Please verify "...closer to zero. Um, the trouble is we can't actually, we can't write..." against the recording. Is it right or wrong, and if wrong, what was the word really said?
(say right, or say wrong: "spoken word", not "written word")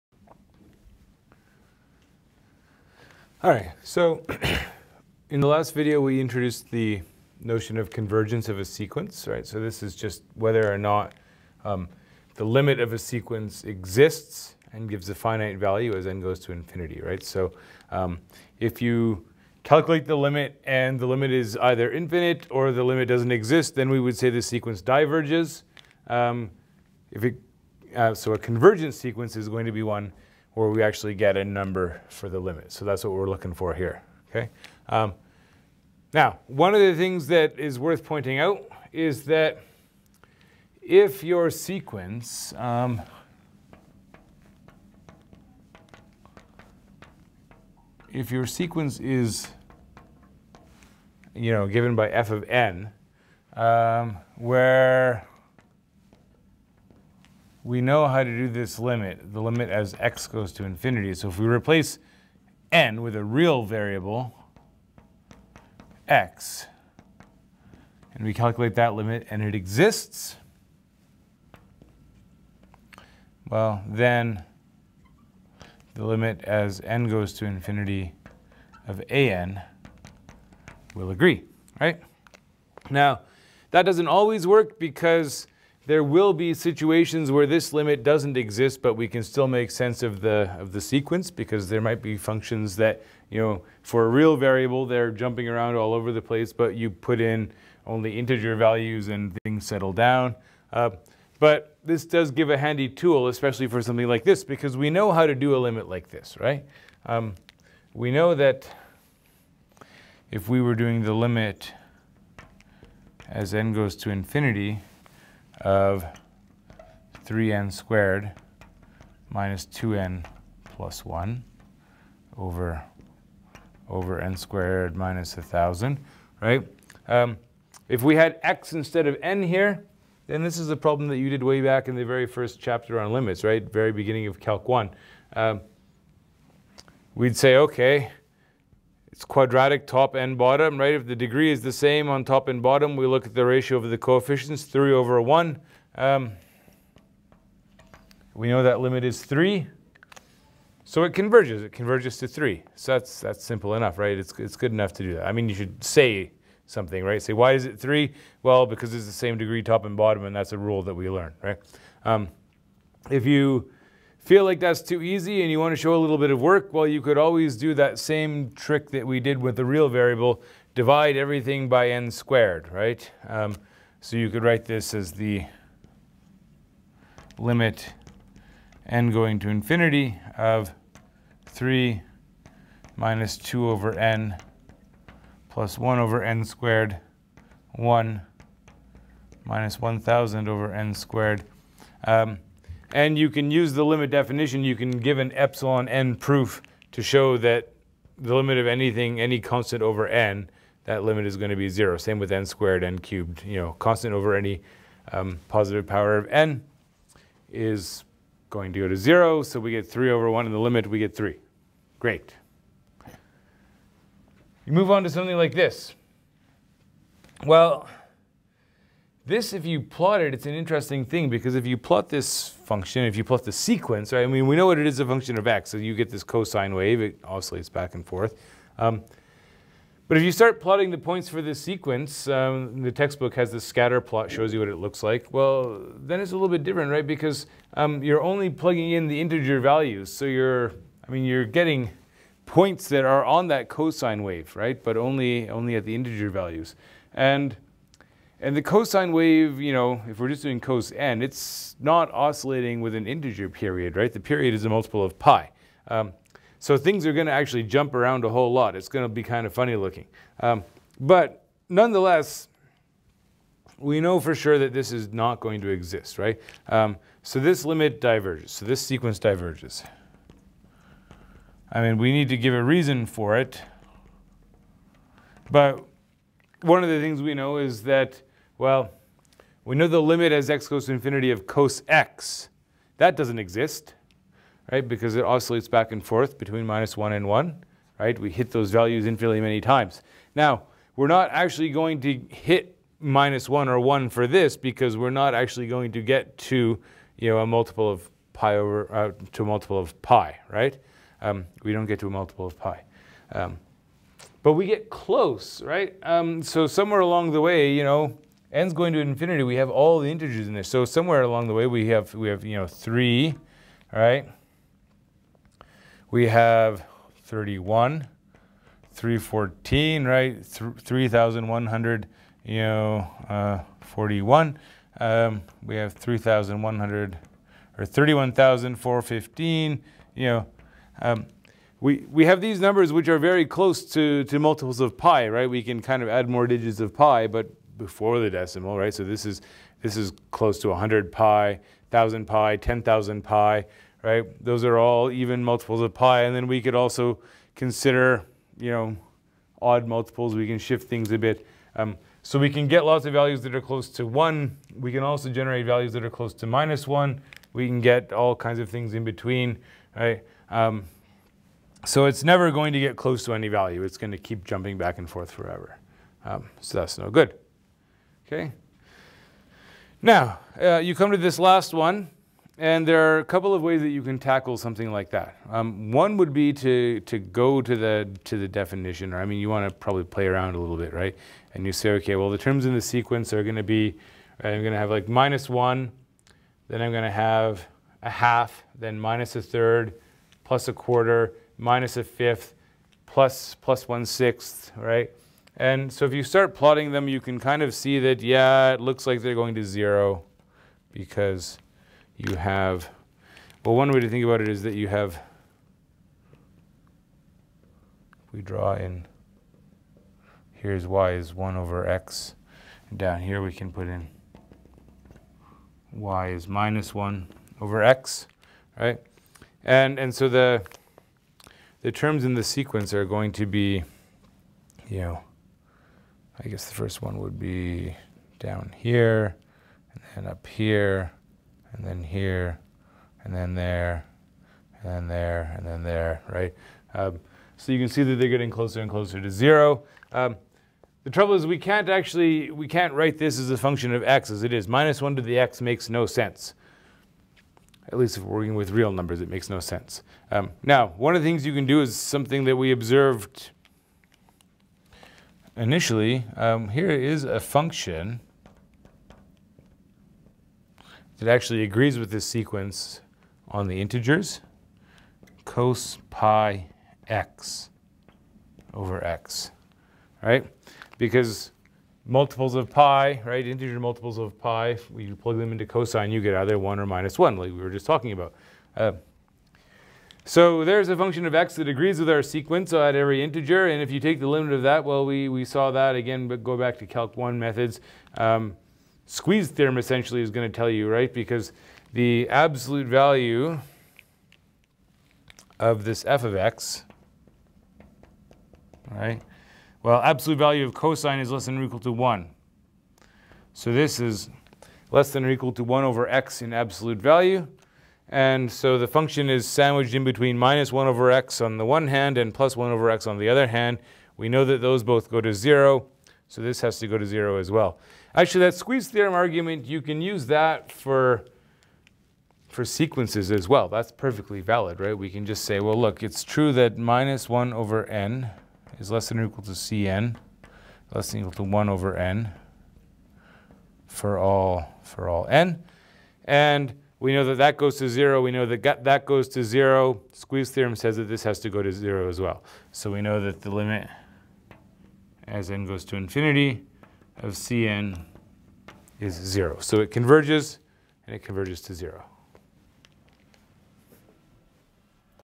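right.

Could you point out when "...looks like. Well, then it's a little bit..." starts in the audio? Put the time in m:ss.
3:54.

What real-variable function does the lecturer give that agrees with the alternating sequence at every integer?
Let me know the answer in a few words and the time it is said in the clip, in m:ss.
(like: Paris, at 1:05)
cos pi x over x, at 7:45.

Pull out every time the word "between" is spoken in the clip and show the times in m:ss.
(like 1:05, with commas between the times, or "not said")
4:46, 5:59, 8:30.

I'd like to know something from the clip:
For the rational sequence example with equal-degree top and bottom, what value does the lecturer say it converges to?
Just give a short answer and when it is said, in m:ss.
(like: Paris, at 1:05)
3, at 2:31.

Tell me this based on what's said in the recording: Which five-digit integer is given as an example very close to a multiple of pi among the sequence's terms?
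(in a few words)
31,415.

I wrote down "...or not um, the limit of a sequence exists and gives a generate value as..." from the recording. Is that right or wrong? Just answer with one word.
wrong.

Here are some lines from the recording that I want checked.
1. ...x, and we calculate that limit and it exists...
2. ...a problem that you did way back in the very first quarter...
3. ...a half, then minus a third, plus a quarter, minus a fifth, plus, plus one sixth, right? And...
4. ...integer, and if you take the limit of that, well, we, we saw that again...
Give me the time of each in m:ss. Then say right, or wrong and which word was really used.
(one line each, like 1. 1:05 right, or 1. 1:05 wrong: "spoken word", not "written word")
1. 1:06 right
2. 2:10 wrong: "chapter", not "quarter"
3. 6:28 right
4. 8:03 right.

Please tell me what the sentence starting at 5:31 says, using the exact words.
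Um, we, we have these numbers which are very close to, to multiples of pi, right?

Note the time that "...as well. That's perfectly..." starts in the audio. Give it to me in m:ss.
8:43.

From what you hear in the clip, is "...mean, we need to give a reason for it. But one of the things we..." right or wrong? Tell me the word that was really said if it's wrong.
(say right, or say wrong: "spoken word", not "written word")
right.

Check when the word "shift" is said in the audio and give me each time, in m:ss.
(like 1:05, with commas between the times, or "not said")
5:50.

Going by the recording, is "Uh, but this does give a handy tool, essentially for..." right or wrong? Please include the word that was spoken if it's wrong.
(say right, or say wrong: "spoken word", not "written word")
wrong: "especially", not "essentially".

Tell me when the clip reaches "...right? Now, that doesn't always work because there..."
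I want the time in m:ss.
1:21.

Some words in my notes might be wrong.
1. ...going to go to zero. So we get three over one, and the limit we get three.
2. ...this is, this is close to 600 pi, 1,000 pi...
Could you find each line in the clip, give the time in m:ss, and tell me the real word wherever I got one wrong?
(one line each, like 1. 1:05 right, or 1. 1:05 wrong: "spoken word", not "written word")
1. 3:28 right
2. 5:39 wrong: "100", not "600".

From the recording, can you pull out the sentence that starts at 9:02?
So we know that the limit as n goes to infinity of Cn is zero.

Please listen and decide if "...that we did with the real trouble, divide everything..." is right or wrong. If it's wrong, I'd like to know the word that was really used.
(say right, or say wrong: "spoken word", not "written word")
wrong: "variable", not "trouble".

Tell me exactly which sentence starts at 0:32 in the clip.
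So that's what we're looking for here, okay?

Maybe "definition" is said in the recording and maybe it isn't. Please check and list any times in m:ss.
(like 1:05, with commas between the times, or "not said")
3:14, 6:18.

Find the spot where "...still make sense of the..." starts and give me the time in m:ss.
1:29.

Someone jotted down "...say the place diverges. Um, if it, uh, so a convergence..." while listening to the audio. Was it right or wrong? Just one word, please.
wrong.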